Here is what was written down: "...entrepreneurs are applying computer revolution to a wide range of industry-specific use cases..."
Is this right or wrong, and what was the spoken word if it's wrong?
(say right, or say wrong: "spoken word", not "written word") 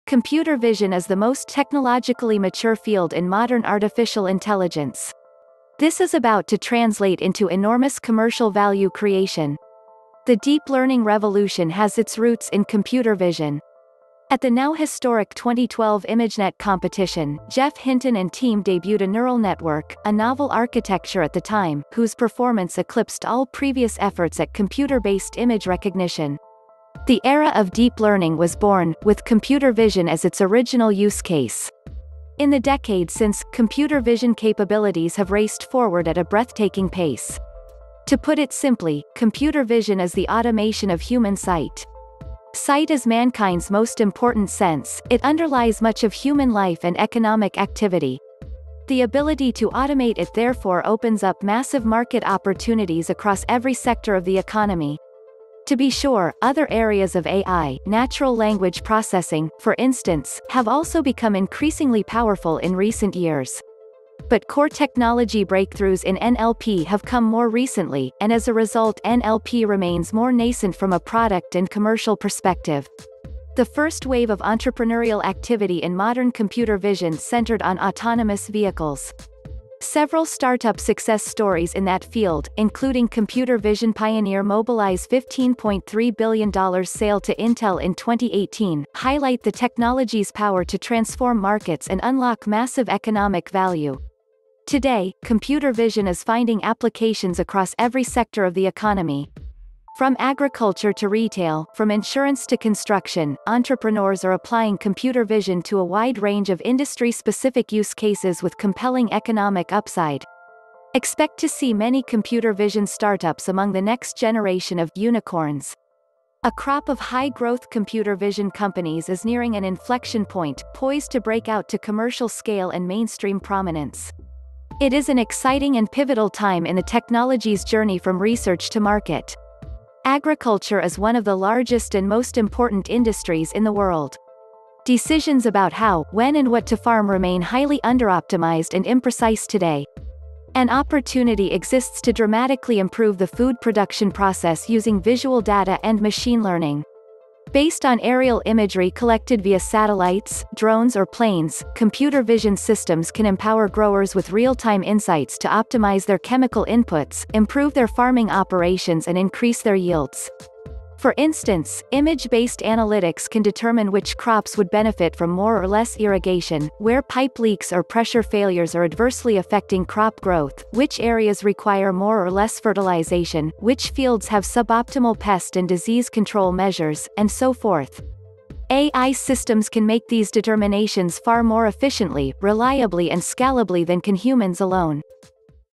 wrong: "vision", not "revolution".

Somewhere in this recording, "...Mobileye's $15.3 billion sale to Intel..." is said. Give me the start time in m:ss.
1:24.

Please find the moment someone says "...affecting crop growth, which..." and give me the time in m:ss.
2:49.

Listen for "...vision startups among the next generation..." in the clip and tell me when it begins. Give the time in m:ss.
1:52.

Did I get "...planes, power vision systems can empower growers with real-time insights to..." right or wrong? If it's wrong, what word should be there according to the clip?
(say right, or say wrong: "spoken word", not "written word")
wrong: "computer", not "power".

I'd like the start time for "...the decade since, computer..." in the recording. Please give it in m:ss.
0:32.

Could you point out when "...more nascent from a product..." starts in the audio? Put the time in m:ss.
1:10.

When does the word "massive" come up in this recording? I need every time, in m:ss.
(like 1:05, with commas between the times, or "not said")
0:51, 1:32.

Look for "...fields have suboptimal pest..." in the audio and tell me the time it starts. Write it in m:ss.
2:53.